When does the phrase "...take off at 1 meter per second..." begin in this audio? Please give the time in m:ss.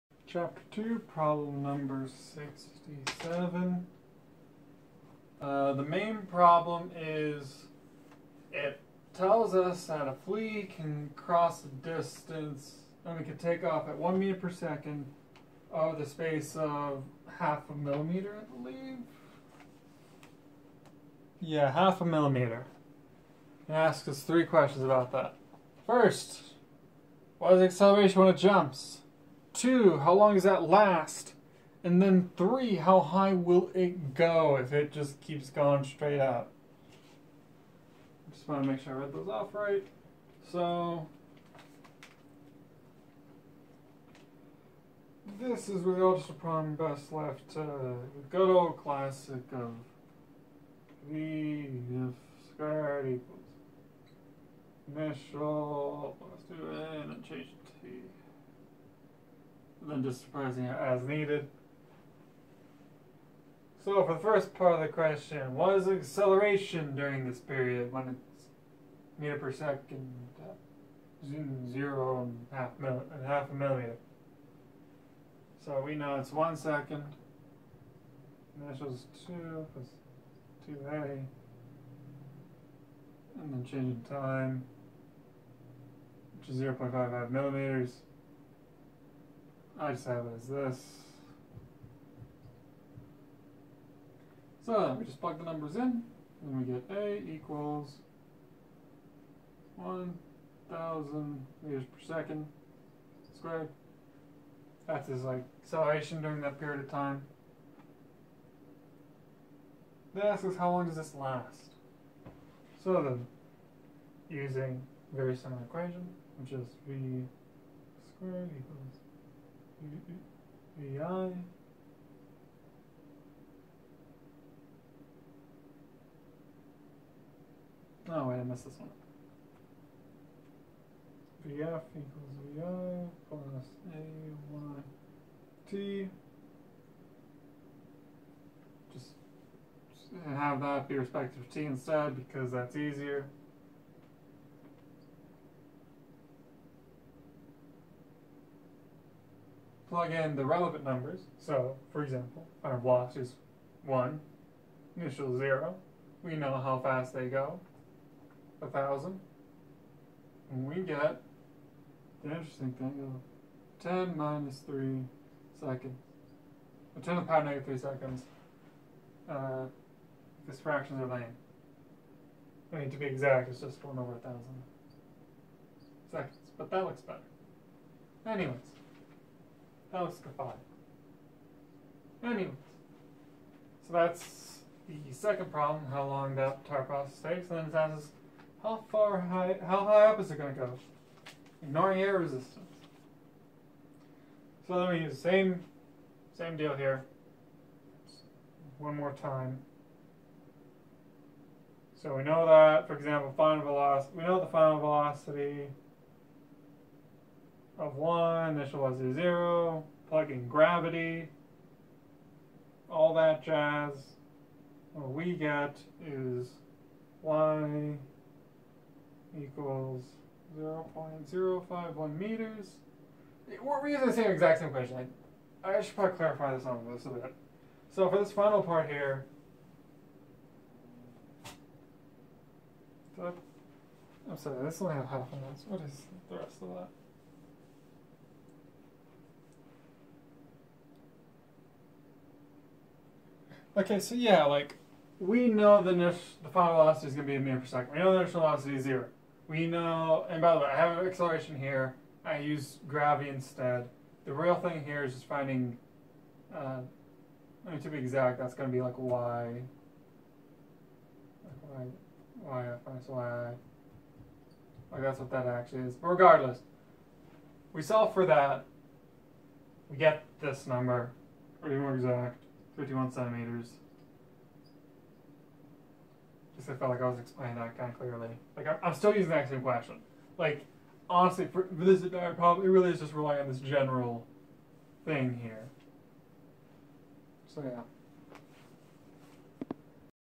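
0:13.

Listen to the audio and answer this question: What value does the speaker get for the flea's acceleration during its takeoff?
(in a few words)
1,000 meters per second squared.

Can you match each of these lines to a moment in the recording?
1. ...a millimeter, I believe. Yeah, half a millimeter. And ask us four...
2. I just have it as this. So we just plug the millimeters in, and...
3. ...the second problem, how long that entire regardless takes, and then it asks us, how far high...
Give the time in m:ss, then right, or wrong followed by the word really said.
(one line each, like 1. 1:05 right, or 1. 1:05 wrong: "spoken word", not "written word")
1. 0:17 wrong: "three", not "four"
2. 1:29 wrong: "numbers", not "millimeters"
3. 3:04 wrong: "process", not "regardless".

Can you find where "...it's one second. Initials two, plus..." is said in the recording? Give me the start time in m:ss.
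1:16.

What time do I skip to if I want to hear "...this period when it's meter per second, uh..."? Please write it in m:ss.
1:07.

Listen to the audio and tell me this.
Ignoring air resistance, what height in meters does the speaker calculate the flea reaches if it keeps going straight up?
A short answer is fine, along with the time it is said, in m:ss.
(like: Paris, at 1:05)
0.051 meters, at 3:41.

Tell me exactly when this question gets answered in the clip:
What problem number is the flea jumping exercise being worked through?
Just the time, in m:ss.
0:02.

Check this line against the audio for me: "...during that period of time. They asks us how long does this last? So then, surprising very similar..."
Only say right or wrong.
wrong.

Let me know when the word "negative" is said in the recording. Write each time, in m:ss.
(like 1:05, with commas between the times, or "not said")
2:47.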